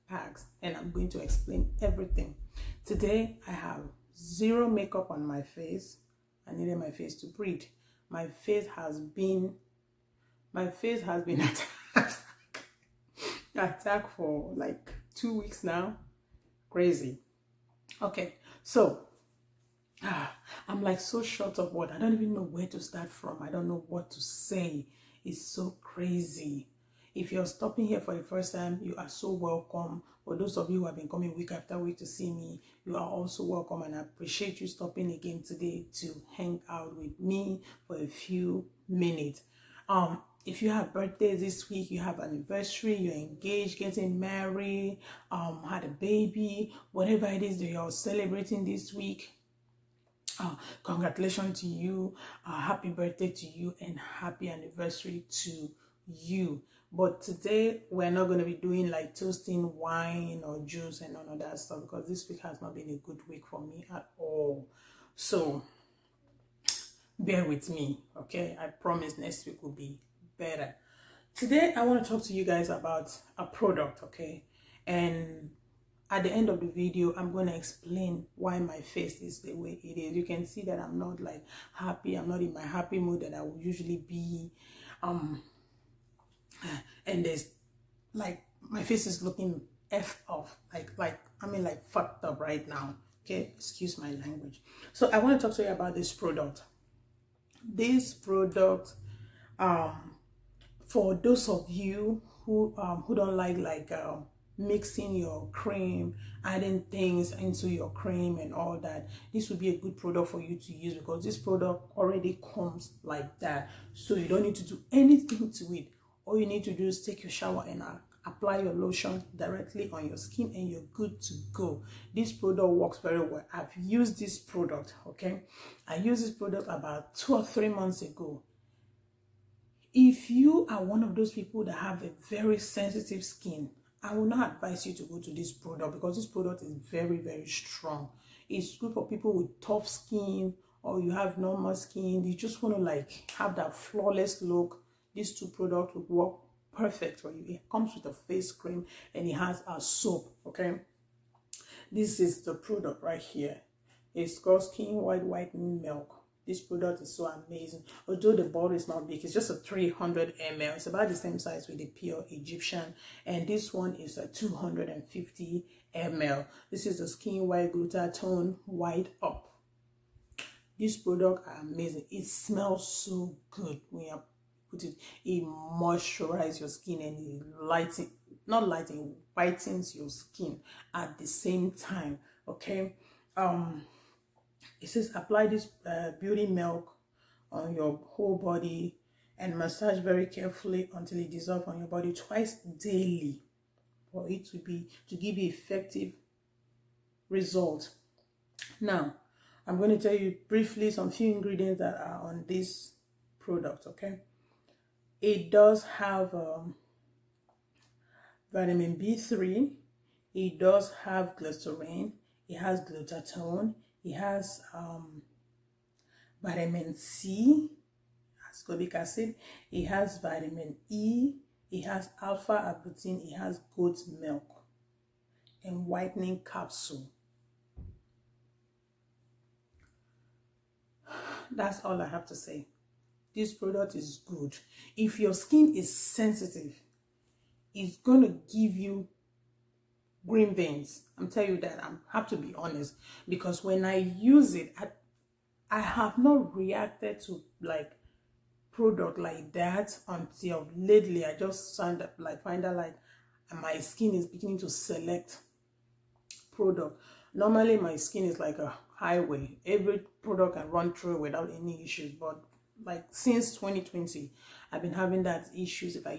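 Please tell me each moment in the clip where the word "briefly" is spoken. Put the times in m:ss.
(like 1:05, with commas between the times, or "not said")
3:20.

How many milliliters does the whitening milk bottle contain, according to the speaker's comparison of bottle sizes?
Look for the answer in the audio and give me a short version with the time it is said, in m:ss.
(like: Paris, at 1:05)
300 ml, at 2:39.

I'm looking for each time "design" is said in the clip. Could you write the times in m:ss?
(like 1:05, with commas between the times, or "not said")
not said.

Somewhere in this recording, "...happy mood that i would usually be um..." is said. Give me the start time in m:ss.
1:22.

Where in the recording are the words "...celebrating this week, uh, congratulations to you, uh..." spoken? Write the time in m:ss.
0:47.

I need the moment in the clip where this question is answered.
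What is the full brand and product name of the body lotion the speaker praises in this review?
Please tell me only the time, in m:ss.
2:34.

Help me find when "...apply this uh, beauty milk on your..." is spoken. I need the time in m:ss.
3:05.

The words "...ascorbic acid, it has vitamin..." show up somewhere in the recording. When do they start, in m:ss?
3:38.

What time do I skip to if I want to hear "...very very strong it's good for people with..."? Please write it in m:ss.
2:16.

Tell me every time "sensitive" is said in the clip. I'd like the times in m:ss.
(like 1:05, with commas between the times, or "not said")
2:12, 3:55.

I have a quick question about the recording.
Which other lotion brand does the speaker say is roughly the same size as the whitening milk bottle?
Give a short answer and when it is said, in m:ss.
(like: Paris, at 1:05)
Pure Egyptian, at 2:41.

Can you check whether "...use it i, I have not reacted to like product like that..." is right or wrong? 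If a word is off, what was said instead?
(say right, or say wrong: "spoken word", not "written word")
right.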